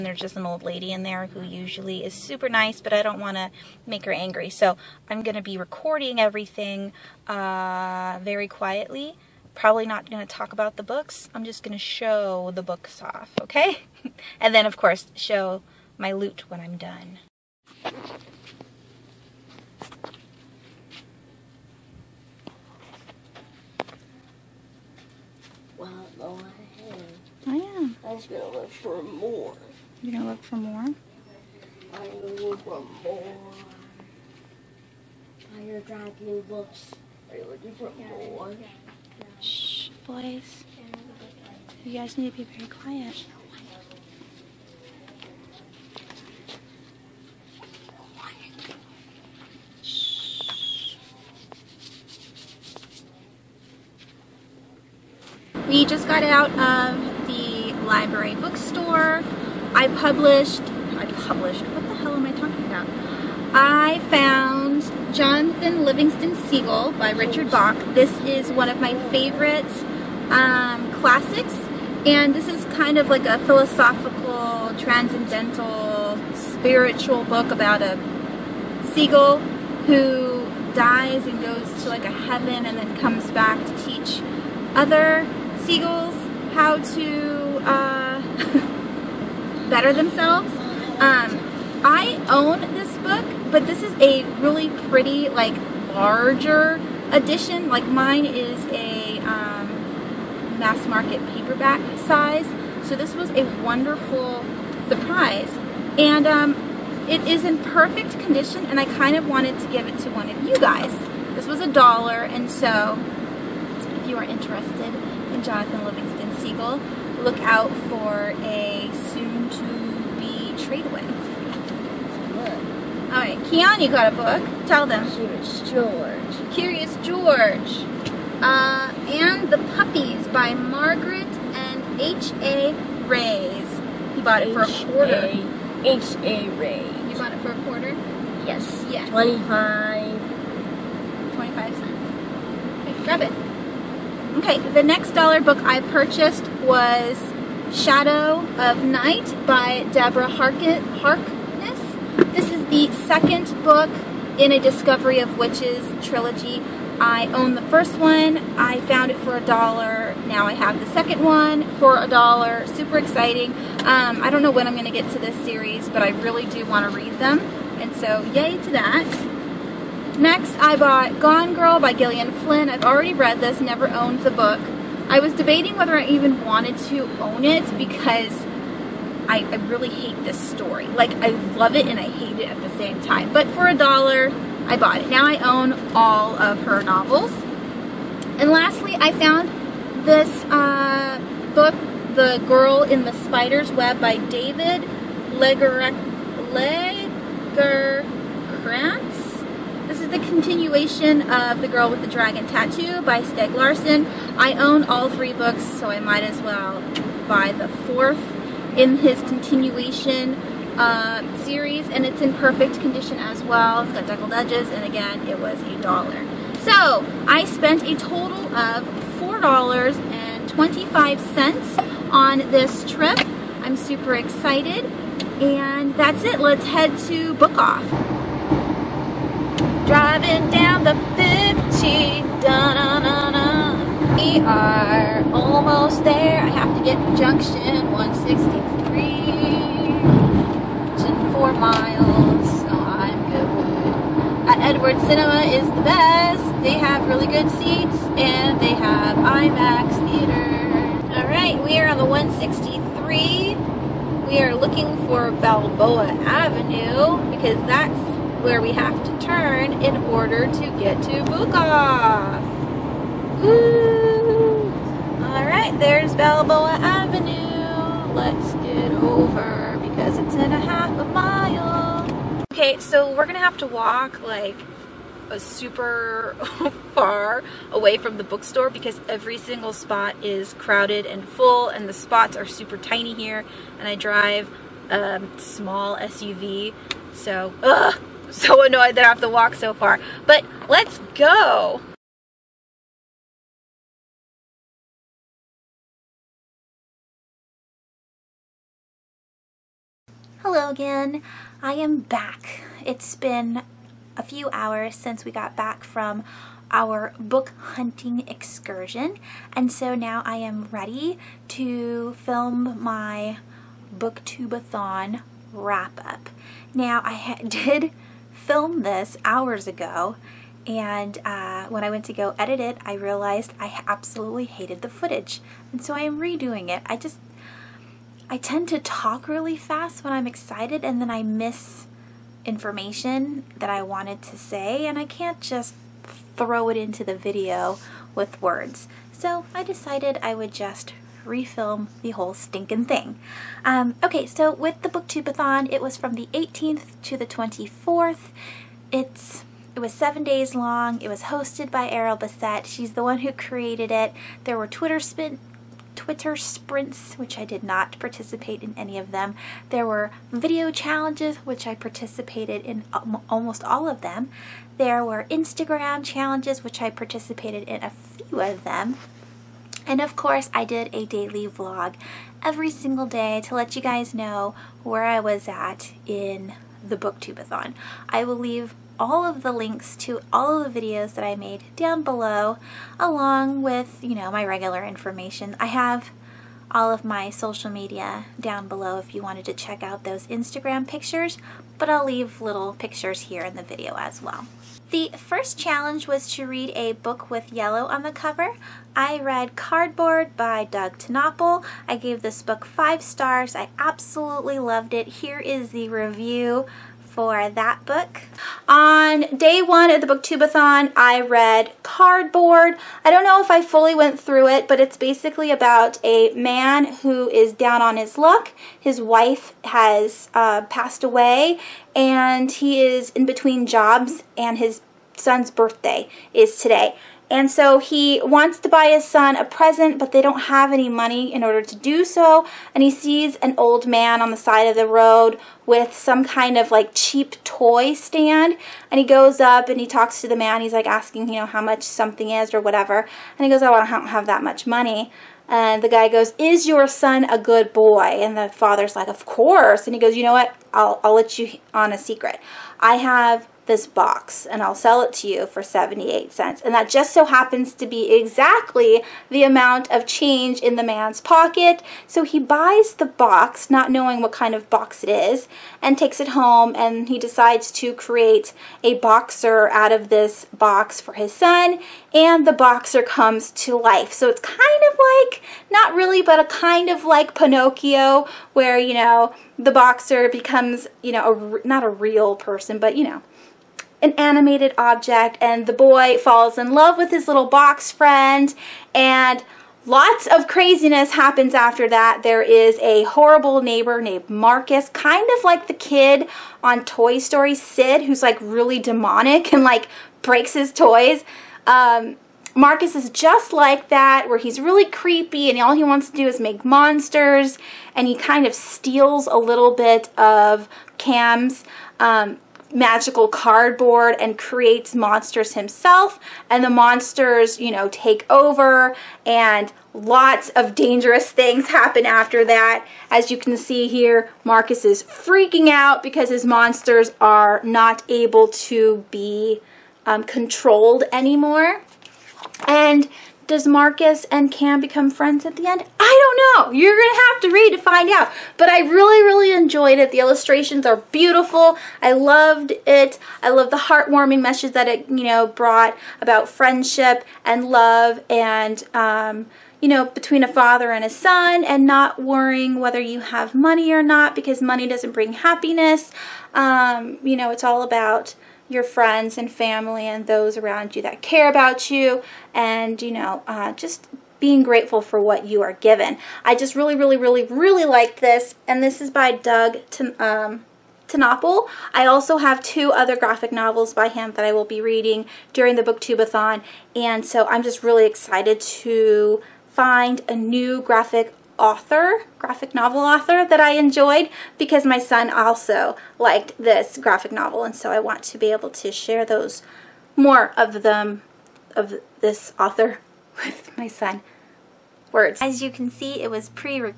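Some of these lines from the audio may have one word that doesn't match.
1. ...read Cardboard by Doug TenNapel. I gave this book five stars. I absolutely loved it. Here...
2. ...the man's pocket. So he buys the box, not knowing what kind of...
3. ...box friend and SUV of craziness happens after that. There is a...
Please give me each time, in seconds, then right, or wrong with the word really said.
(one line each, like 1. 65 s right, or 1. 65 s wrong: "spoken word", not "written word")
1. 399 s right
2. 460 s right
3. 487 s wrong: "Lots", not "SUV".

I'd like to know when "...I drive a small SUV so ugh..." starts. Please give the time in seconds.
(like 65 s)
283 s.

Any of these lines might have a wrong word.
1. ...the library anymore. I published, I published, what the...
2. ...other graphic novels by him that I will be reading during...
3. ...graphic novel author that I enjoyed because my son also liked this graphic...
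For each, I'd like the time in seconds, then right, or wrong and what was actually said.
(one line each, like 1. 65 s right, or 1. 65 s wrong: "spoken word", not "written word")
1. 57 s wrong: "bookstore", not "anymore"
2. 572 s right
3. 582 s right.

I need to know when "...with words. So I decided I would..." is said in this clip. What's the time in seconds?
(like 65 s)
338 s.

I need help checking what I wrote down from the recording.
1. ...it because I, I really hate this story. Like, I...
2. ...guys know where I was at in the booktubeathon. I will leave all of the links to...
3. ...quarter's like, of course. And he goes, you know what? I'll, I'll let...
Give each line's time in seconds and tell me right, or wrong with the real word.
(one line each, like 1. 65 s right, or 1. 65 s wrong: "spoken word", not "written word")
1. 177 s right
2. 373 s right
3. 448 s wrong: "father", not "quarter".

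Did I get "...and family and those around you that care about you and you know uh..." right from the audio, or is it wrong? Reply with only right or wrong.
right.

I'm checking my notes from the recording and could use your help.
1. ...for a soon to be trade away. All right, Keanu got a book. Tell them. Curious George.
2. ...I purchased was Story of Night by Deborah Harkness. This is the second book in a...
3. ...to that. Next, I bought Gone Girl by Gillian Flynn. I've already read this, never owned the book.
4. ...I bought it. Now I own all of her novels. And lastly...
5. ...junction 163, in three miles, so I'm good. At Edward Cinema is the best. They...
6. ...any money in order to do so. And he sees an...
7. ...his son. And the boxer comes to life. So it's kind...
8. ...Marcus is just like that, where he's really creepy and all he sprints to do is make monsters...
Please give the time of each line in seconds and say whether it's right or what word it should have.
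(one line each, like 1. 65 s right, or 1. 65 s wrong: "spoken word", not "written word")
1. 117 s right
2. 145 s wrong: "Shadow", not "Story"
3. 168 s right
4. 184 s right
5. 237 s wrong: "four", not "three"
6. 430 s right
7. 471 s right
8. 502 s wrong: "wants", not "sprints".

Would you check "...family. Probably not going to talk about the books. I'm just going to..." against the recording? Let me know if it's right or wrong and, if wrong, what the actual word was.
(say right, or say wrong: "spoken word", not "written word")
wrong: "quietly", not "family".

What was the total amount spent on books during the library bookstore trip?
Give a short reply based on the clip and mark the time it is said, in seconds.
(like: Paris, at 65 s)
$4.25, at 219 s.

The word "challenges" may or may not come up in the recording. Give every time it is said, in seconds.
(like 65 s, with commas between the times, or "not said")
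360 s, 366 s, 395 s.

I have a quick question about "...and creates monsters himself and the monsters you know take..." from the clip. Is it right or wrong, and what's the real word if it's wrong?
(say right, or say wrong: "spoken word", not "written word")
right.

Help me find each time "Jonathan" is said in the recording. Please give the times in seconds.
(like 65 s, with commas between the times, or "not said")
65 s, 115 s.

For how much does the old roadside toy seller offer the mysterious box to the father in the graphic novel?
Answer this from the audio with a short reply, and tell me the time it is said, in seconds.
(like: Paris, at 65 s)
78 cents, at 455 s.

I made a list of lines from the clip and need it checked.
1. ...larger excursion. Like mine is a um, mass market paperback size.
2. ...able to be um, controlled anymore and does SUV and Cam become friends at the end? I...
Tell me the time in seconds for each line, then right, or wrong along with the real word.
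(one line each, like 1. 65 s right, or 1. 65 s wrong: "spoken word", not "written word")
1. 95 s wrong: "edition", not "excursion"
2. 528 s wrong: "Marcus", not "SUV".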